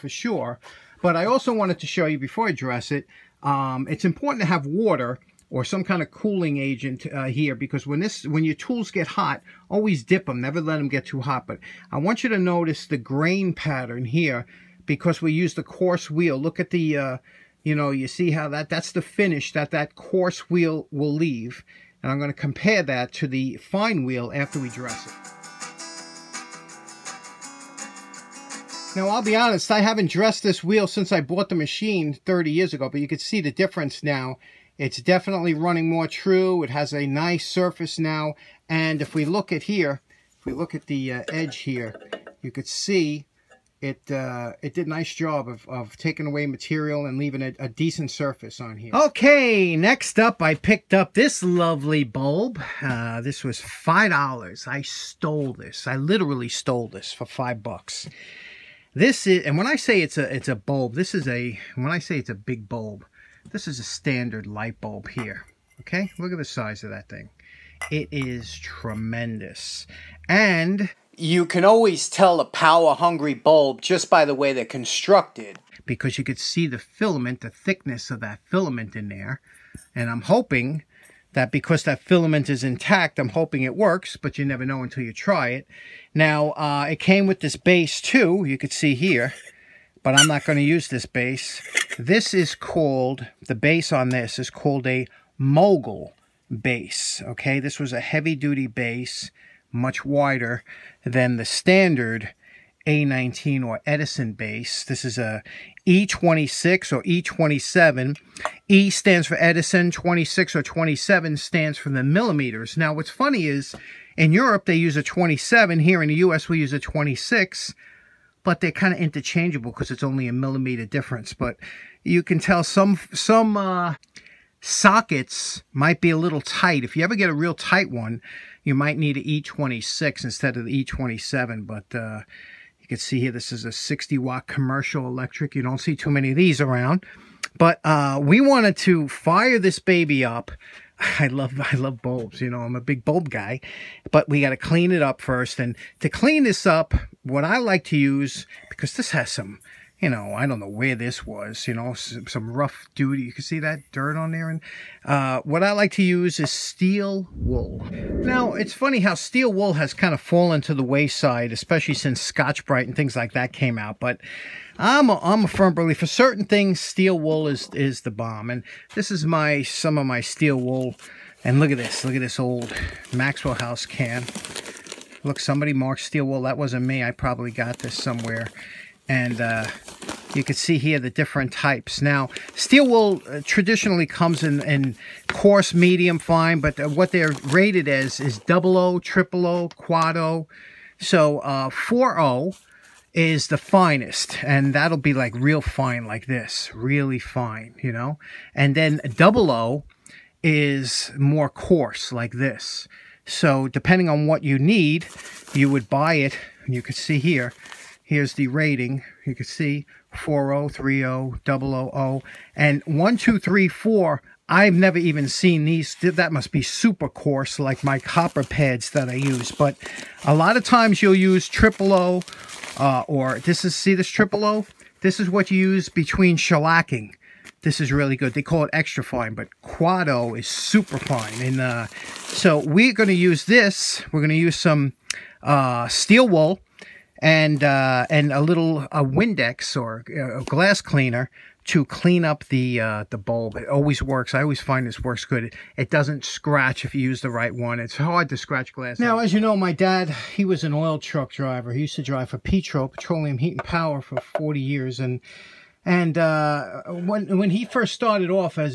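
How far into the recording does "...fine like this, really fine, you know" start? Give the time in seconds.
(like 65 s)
195 s.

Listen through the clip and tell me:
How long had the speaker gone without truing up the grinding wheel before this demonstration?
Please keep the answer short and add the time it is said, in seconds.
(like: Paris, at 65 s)
30 years, at 32 s.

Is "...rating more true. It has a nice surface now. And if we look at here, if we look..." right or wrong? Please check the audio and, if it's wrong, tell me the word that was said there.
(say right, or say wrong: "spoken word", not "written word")
wrong: "running", not "rating".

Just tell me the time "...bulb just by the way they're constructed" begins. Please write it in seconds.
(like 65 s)
73 s.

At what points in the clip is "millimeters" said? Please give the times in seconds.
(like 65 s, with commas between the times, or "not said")
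112 s, 120 s.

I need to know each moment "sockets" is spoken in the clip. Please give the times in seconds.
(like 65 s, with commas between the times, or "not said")
124 s.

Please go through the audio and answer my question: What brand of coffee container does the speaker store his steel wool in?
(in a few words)
Maxwell House.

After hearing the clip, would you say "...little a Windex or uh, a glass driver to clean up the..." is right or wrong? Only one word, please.
wrong.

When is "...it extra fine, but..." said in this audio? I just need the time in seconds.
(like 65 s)
228 s.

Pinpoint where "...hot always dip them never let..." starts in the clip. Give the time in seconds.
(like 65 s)
9 s.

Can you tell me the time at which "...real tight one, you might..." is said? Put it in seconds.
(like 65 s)
127 s.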